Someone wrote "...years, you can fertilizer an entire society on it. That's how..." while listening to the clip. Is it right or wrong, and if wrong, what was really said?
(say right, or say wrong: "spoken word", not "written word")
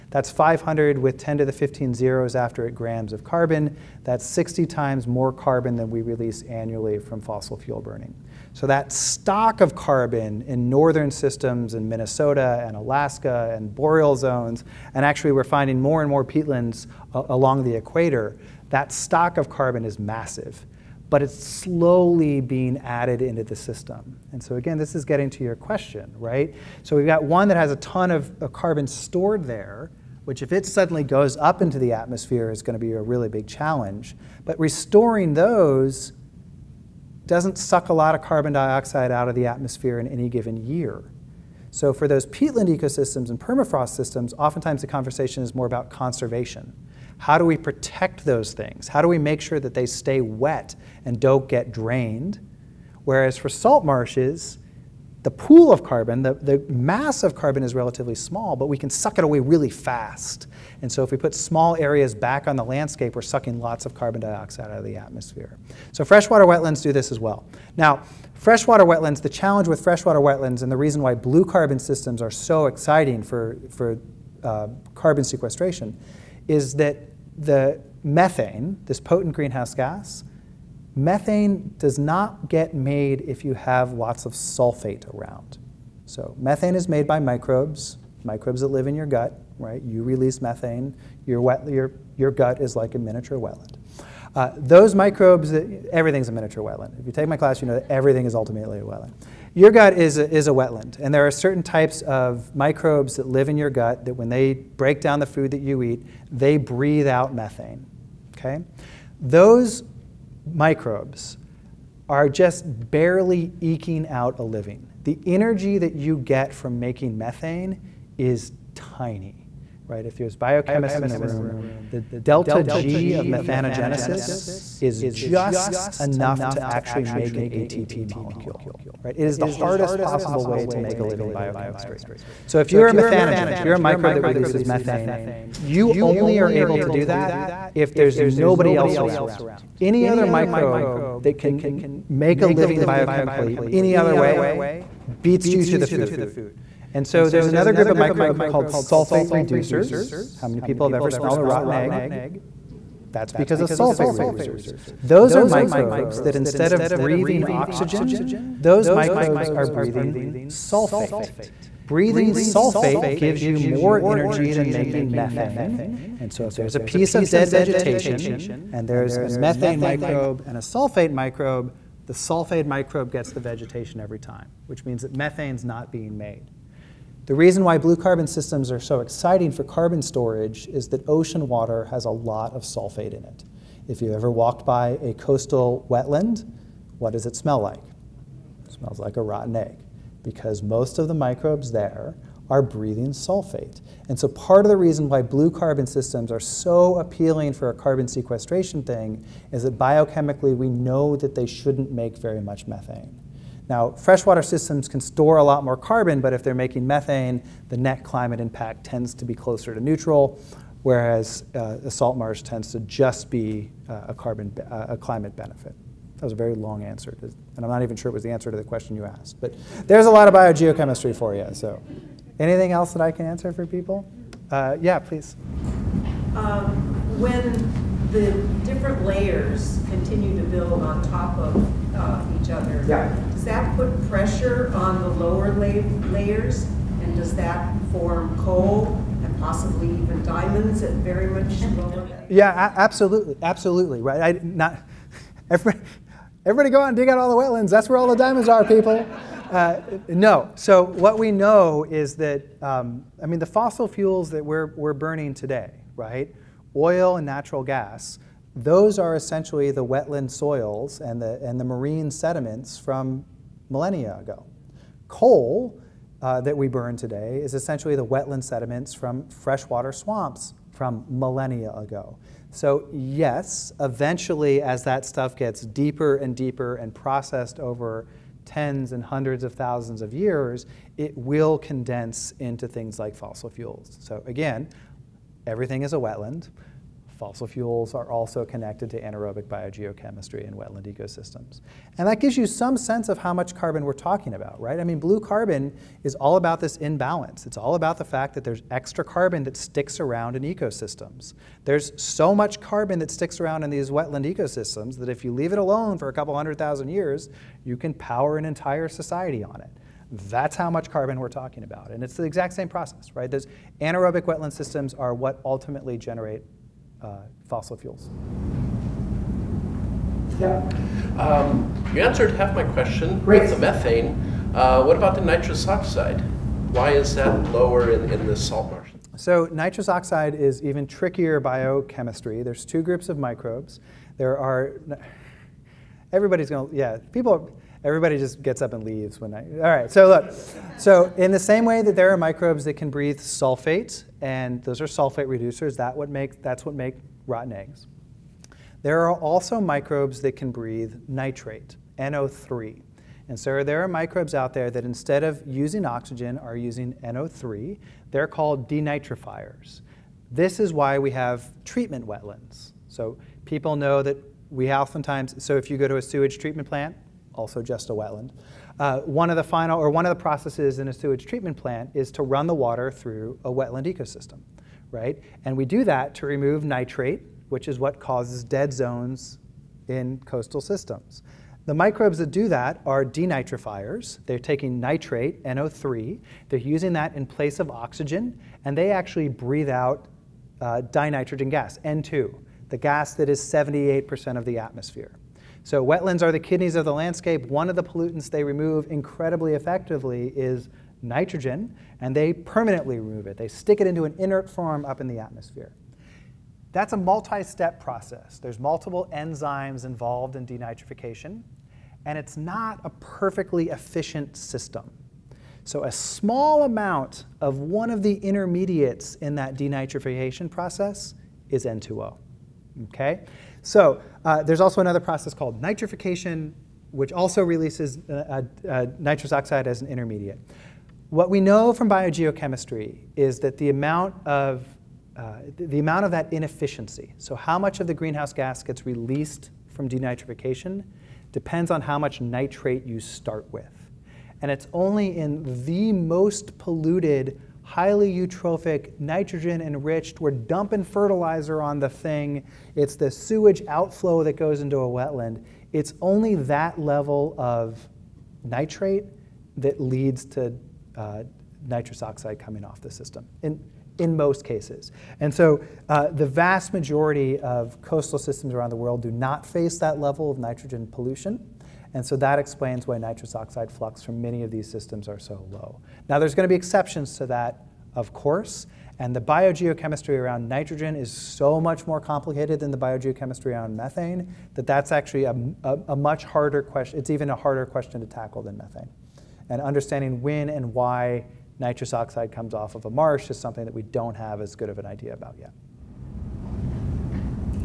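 wrong: "power", not "fertilizer".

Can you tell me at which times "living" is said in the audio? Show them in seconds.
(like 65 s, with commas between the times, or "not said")
114 s, 131 s, 142 s.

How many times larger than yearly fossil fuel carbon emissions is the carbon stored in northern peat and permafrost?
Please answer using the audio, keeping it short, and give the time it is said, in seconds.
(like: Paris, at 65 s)
60 times, at 4 s.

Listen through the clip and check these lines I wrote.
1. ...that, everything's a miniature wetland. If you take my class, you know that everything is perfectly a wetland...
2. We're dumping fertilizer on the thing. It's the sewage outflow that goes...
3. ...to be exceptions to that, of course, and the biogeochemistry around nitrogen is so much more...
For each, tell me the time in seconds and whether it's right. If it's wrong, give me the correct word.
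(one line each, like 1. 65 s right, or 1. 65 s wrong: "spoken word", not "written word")
1. 95 s wrong: "ultimately", not "perfectly"
2. 450 s right
3. 476 s right.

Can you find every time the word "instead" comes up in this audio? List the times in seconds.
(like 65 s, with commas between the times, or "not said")
156 s, 354 s.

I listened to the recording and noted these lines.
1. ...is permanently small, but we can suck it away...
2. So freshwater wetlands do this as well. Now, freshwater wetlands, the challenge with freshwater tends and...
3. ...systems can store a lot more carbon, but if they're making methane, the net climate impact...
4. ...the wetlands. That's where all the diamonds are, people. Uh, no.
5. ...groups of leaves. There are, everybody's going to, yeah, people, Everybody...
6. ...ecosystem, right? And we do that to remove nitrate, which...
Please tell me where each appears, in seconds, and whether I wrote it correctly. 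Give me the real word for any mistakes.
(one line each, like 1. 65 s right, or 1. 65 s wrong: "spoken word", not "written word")
1. 57 s wrong: "relatively", not "permanently"
2. 65 s wrong: "wetlands", not "tends"
3. 204 s right
4. 247 s right
5. 332 s wrong: "microbes", not "leaves"
6. 373 s right.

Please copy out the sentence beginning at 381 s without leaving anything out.
The microbes that do that are denitrifiers.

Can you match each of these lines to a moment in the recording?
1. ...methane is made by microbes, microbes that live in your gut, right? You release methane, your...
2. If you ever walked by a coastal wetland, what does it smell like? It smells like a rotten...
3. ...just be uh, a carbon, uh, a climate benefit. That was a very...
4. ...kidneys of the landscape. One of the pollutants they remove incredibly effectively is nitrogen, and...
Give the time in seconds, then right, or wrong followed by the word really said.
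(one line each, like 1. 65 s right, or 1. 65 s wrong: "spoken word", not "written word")
1. 86 s right
2. 183 s right
3. 212 s right
4. 396 s right.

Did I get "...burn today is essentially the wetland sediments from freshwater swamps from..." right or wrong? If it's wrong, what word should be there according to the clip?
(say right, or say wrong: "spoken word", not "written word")
right.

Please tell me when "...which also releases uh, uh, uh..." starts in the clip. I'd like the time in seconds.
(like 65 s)
426 s.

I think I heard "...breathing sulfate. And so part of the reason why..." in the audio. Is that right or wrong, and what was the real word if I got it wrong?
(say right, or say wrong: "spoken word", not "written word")
right.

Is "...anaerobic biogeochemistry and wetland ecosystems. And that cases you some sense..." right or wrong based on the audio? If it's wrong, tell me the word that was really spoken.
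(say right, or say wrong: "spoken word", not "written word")
wrong: "gives", not "cases".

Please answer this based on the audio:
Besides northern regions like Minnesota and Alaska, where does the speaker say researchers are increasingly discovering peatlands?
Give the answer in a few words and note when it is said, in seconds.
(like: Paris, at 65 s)
Along the equator, at 17 s.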